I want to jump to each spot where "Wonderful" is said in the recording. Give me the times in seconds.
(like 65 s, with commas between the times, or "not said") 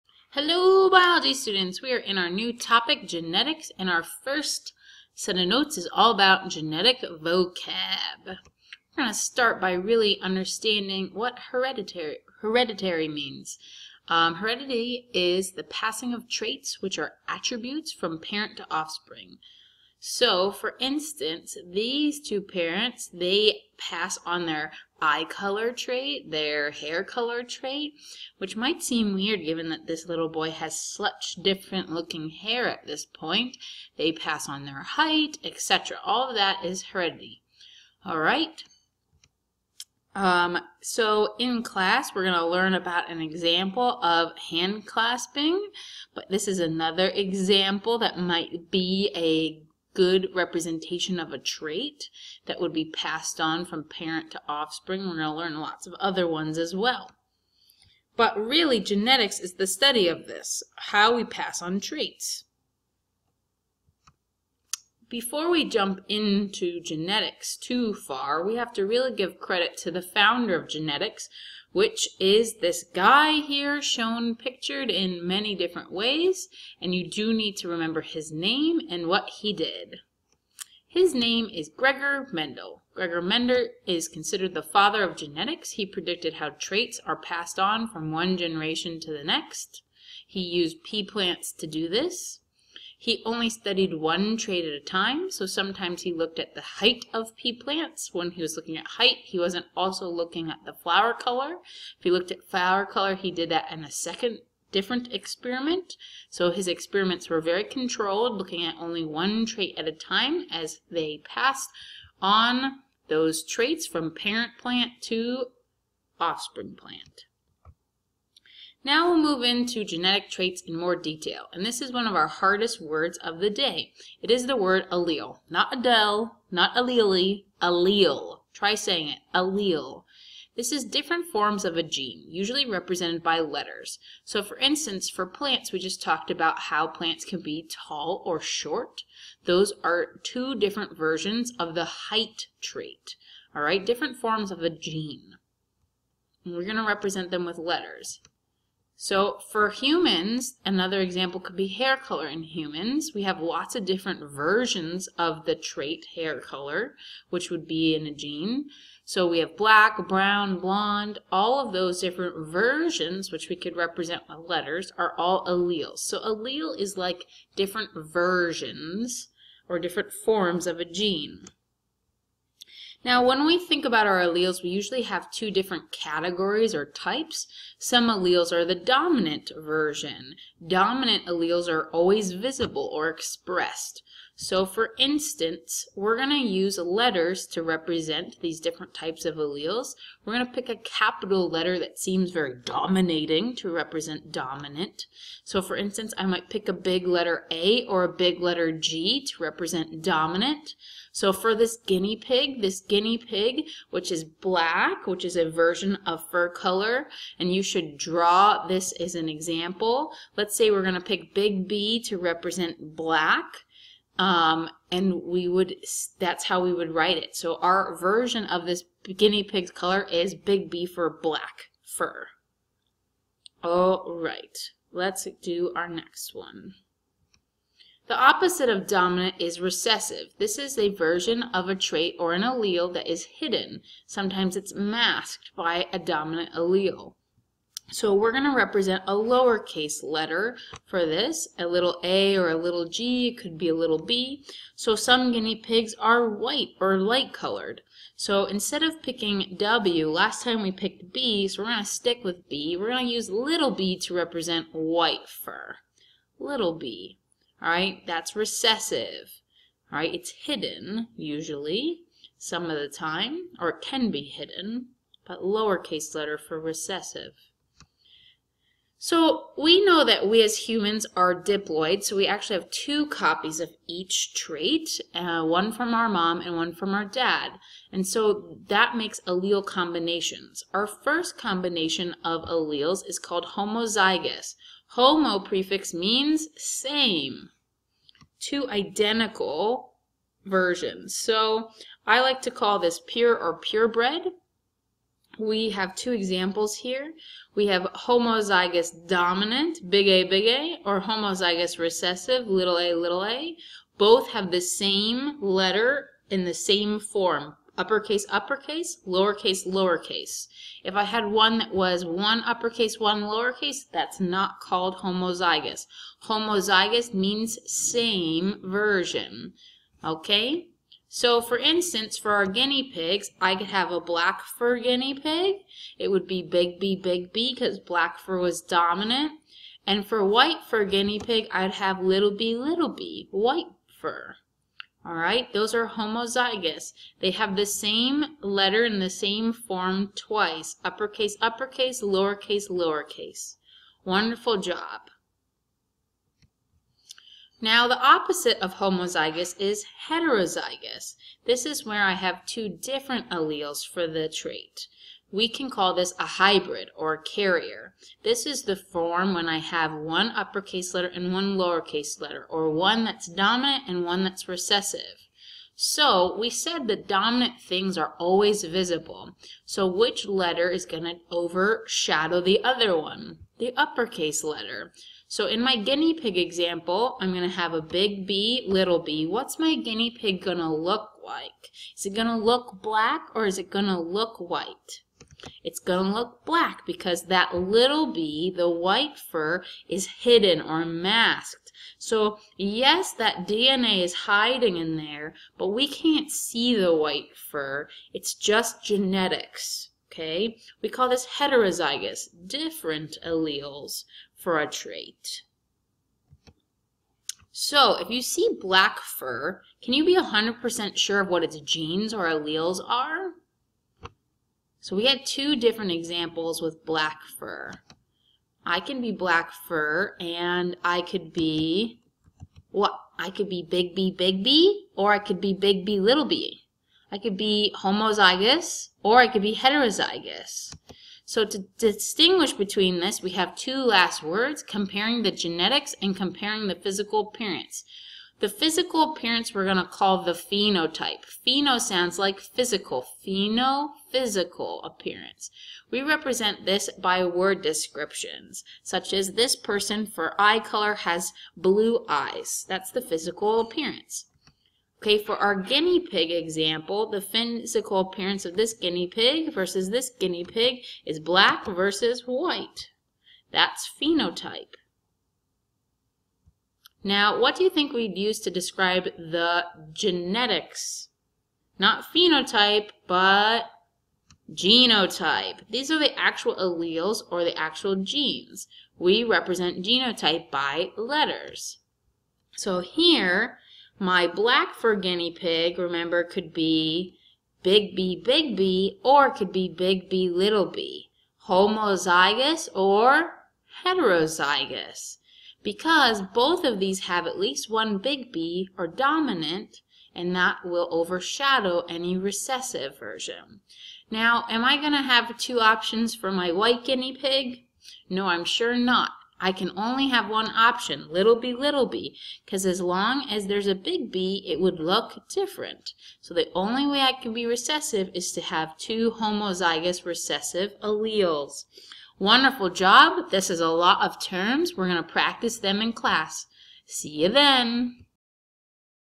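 344 s, 522 s.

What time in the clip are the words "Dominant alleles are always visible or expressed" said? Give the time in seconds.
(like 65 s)
180 s.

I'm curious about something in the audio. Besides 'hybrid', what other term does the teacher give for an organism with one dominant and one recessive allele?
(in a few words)
Carrier.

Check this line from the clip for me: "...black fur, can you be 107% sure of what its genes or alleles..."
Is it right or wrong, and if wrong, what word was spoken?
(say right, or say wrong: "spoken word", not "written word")
wrong: "100", not "107".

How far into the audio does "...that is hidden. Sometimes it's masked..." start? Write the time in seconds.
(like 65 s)
232 s.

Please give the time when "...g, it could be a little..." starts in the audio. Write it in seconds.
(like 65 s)
242 s.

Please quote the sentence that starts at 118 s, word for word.
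Now we'll move into genetic traits in more detail, and this is one of our hardest words of the day.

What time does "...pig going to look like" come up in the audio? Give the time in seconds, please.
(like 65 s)
380 s.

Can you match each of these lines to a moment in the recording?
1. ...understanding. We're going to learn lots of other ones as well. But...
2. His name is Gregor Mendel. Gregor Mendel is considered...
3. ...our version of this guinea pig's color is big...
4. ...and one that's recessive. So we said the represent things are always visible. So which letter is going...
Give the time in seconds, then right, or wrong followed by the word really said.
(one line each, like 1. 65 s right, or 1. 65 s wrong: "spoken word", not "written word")
1. 54 s wrong: "offspring", not "understanding"
2. 80 s right
3. 217 s right
4. 363 s wrong: "dominant", not "represent".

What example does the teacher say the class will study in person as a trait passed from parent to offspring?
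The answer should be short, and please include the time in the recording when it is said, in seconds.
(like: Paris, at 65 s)
Hand clasping, at 44 s.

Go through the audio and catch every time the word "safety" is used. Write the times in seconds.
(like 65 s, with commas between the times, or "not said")
not said.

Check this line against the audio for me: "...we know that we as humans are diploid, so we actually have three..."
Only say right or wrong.
wrong.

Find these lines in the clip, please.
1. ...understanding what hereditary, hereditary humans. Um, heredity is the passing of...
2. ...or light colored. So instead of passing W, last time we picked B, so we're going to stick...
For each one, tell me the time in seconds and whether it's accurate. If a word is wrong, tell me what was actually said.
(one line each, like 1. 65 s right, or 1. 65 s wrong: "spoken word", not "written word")
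1. 10 s wrong: "means", not "humans"
2. 246 s wrong: "picking", not "passing".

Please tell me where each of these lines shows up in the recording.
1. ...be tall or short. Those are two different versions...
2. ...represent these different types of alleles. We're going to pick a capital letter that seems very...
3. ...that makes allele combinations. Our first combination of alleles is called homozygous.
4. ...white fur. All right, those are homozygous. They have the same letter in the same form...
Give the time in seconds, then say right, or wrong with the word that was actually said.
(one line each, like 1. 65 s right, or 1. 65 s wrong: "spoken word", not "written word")
1. 137 s right
2. 187 s right
3. 278 s right
4. 333 s right.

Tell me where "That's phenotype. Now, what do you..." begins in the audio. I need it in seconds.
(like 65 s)
463 s.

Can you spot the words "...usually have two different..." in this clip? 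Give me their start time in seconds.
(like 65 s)
174 s.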